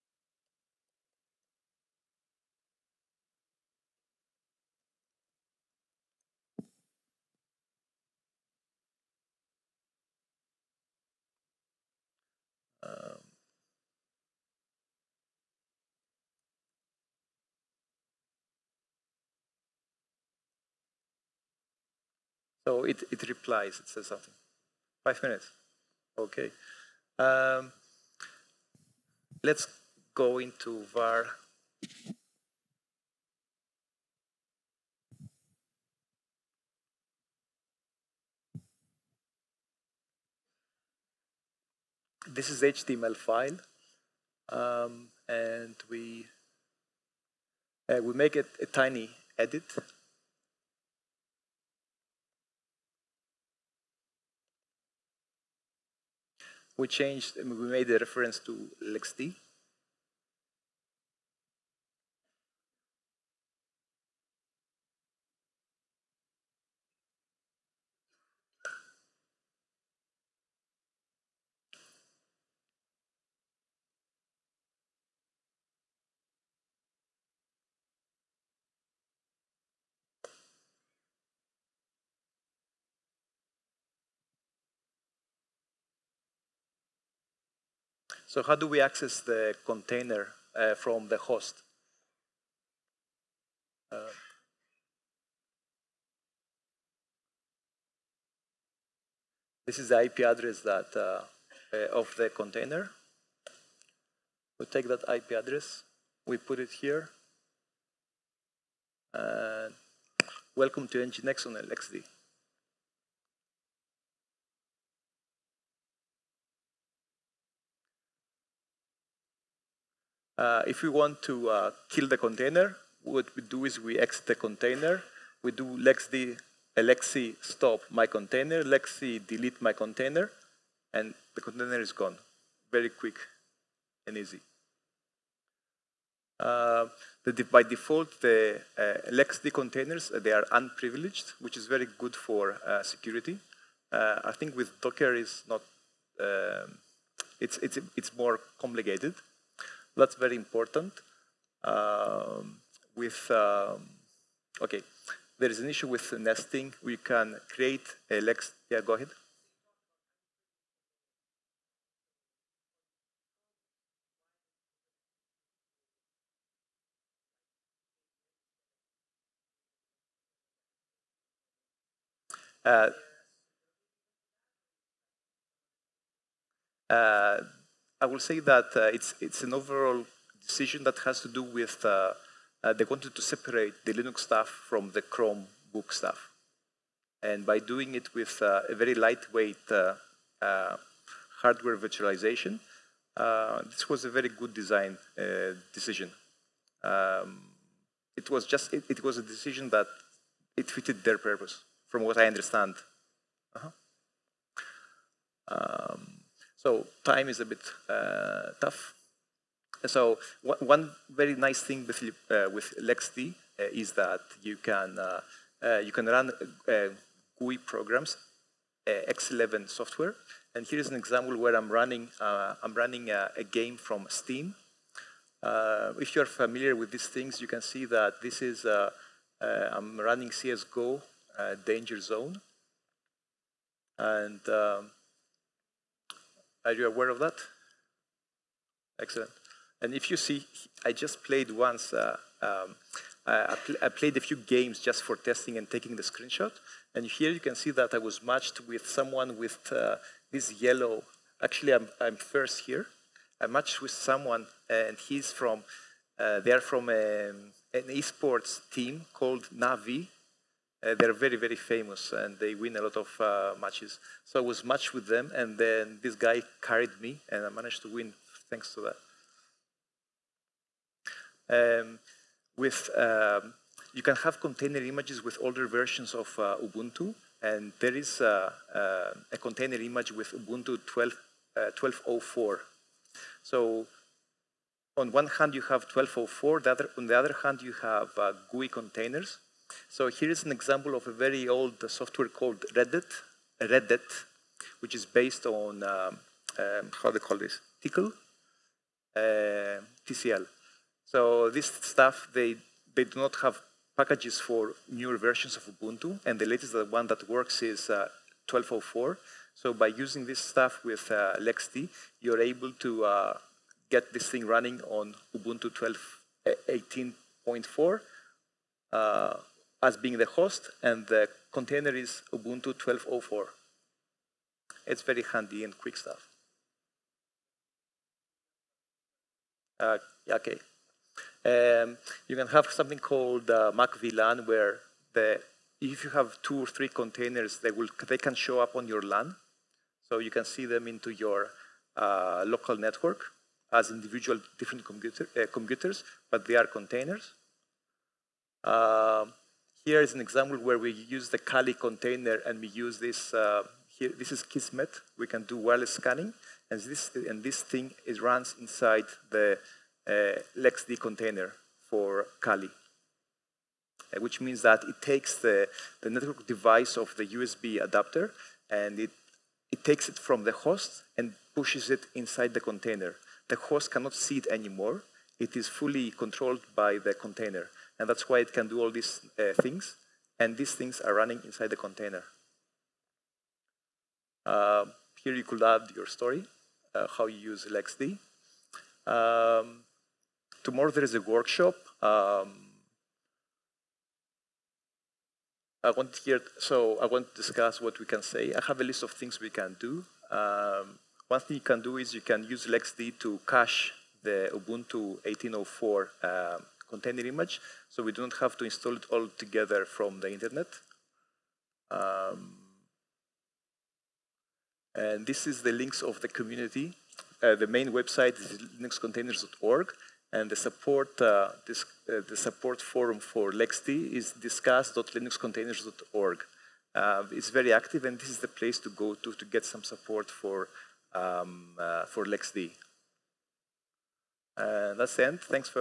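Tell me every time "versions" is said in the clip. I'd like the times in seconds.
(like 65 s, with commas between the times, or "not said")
275 s, 305 s.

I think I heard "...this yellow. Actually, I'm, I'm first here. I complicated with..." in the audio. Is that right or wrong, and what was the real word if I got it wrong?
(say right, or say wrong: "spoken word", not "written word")
wrong: "matched", not "complicated".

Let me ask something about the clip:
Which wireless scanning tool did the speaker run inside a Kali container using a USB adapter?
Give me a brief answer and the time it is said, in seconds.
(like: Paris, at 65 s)
Kismet, at 354 s.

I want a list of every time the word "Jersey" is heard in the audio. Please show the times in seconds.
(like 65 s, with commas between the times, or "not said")
not said.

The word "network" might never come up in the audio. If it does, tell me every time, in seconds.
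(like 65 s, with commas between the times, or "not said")
342 s, 366 s.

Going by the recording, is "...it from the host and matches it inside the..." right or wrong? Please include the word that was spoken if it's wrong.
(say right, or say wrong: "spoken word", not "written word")
wrong: "pushes", not "matches".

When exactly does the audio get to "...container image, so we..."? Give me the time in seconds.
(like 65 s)
406 s.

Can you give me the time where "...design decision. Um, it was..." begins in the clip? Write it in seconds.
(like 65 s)
194 s.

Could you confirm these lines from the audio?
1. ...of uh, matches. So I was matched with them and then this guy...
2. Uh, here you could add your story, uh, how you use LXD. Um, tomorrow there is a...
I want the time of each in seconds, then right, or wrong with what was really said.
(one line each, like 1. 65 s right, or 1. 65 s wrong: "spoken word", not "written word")
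1. 262 s right
2. 384 s right.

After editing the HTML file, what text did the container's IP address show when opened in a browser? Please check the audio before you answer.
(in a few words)
Welcome to NGINX on LXD.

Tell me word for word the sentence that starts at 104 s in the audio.
We take that IP address, we put it here.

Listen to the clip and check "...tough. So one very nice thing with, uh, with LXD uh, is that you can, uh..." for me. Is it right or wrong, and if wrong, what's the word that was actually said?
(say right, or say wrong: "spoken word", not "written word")
right.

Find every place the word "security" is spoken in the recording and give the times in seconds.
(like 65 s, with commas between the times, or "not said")
142 s.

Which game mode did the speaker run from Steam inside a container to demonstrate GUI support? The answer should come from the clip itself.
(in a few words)
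CSGO Danger Zone.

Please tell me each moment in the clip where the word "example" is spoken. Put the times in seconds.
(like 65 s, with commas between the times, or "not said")
220 s, 290 s, 350 s.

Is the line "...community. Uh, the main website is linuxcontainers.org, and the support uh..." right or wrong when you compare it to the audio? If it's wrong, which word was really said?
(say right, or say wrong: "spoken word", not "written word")
right.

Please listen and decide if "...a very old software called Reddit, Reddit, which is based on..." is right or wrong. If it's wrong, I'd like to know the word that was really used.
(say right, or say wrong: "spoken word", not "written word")
right.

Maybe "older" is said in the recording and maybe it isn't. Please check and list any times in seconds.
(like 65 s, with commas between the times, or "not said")
275 s.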